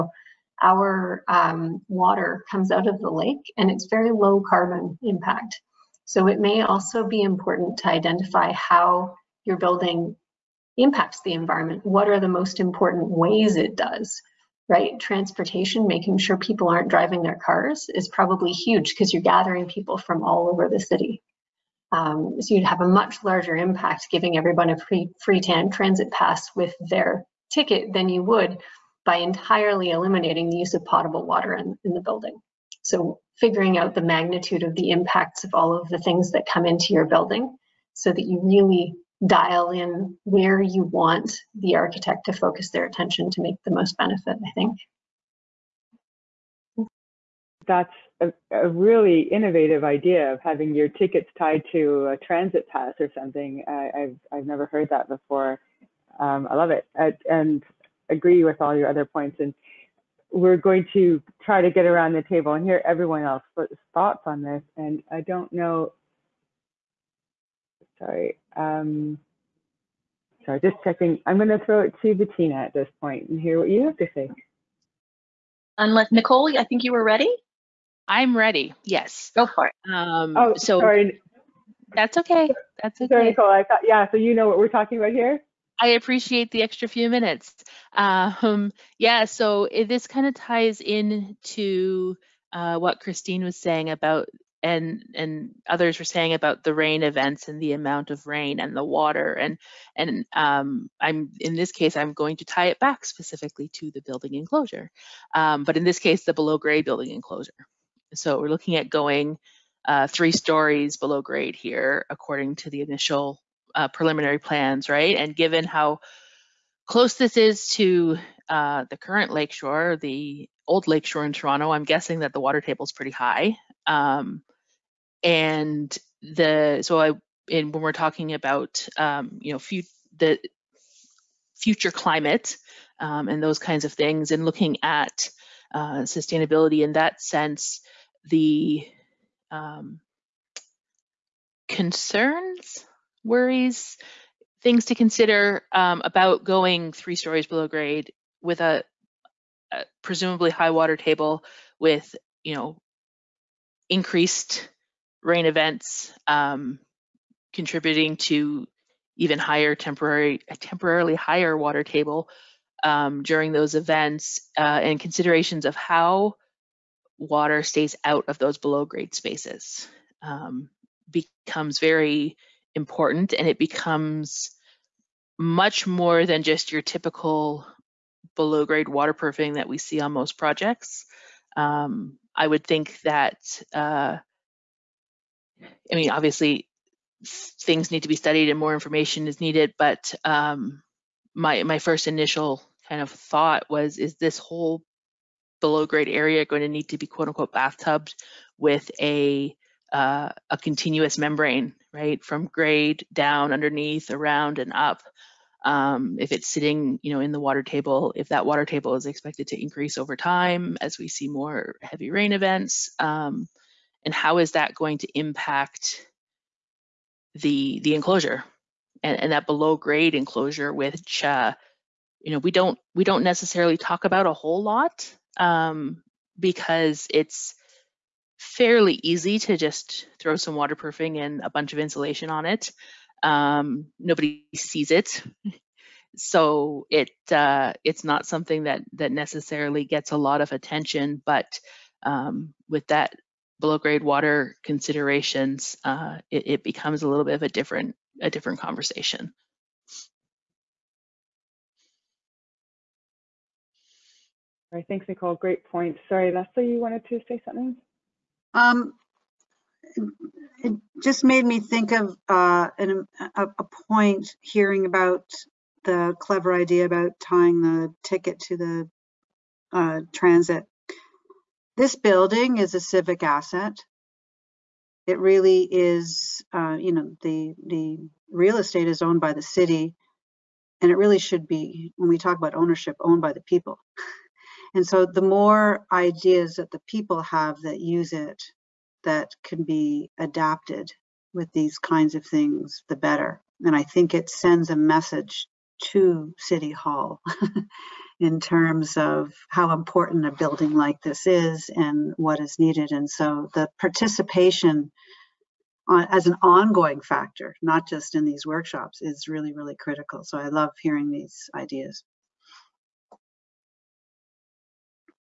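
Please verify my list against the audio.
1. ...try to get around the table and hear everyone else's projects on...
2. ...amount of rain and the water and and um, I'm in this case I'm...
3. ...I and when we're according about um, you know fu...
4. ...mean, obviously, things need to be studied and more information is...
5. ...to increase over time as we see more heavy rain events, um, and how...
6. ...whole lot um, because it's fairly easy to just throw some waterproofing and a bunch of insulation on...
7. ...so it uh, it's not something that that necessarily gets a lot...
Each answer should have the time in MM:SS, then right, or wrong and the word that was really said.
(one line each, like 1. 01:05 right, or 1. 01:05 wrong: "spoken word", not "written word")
1. 01:01 wrong: "thoughts", not "projects"
2. 01:37 right
3. 02:07 wrong: "talking", not "according"
4. 03:05 right
5. 03:29 right
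6. 03:44 right
7. 03:56 right.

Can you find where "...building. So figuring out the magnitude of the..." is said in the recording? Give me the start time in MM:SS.
00:32.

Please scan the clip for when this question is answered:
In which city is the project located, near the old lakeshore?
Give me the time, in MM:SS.
02:01.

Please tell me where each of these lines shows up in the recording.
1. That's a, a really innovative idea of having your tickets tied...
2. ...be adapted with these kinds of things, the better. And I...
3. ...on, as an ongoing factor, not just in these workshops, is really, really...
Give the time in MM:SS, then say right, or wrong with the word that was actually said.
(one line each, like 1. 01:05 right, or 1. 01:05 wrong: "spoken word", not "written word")
1. 00:47 right
2. 04:49 right
3. 05:05 right.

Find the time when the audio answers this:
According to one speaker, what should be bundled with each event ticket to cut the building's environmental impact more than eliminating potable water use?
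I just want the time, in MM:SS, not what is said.
00:24.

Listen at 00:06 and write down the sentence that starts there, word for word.
So it may also be important to identify how your building impacts the environment.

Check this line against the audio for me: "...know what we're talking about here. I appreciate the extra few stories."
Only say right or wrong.
wrong.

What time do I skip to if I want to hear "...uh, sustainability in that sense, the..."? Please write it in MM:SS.
02:15.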